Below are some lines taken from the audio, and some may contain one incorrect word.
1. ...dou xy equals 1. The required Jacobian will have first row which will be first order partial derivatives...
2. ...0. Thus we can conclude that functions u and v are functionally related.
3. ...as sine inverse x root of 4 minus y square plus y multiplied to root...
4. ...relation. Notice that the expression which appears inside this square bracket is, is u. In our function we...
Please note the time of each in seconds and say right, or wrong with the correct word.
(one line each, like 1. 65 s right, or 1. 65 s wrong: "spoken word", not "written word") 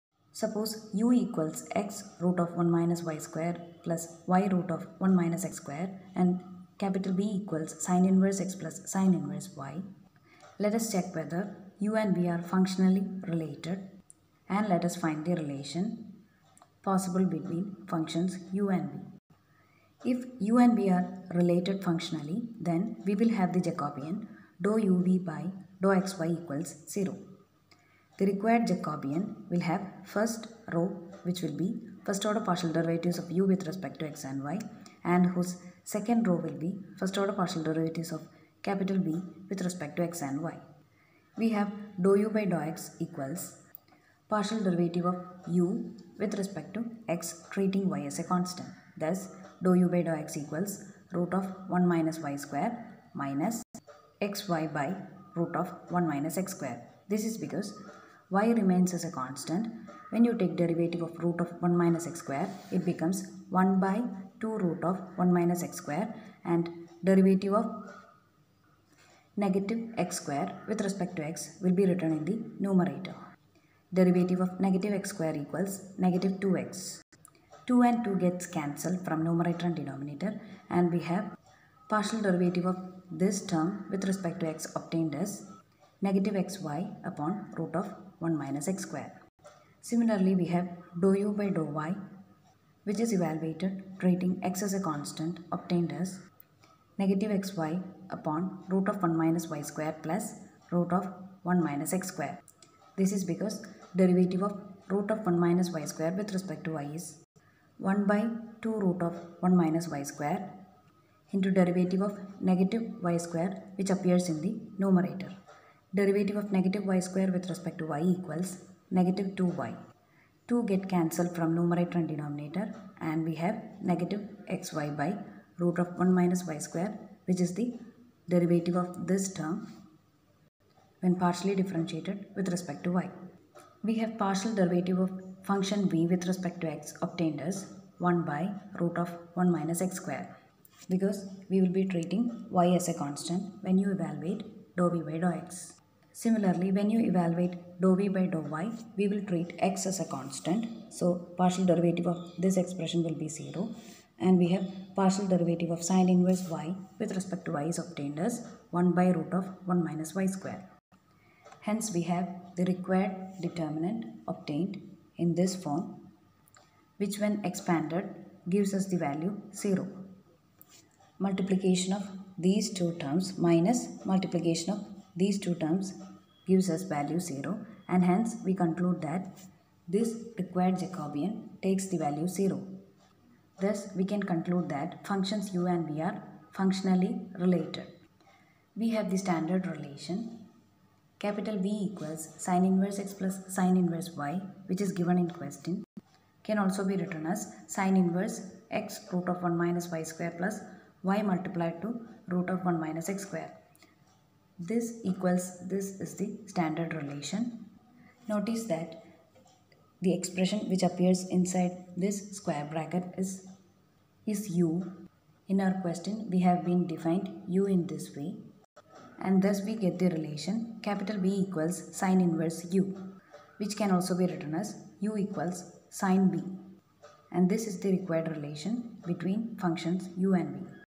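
1. 25 s wrong: "0", not "1"
2. 182 s right
3. 197 s wrong: "1", not "4"
4. 206 s wrong: "question", not "function".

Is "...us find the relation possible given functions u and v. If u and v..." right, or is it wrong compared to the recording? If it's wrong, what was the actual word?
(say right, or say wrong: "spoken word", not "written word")
wrong: "between", not "given".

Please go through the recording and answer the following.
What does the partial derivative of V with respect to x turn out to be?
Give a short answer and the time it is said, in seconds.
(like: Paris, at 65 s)
1 by root of 1 minus x square, at 137 s.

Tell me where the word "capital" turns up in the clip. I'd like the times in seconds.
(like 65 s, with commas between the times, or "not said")
6 s, 38 s, 191 s, 220 s.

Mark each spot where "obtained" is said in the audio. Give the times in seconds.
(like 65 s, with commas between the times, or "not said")
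84 s, 95 s, 137 s, 157 s, 164 s.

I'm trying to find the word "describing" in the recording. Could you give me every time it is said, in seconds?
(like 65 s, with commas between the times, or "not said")
not said.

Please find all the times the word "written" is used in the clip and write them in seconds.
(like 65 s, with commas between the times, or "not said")
71 s, 196 s, 224 s.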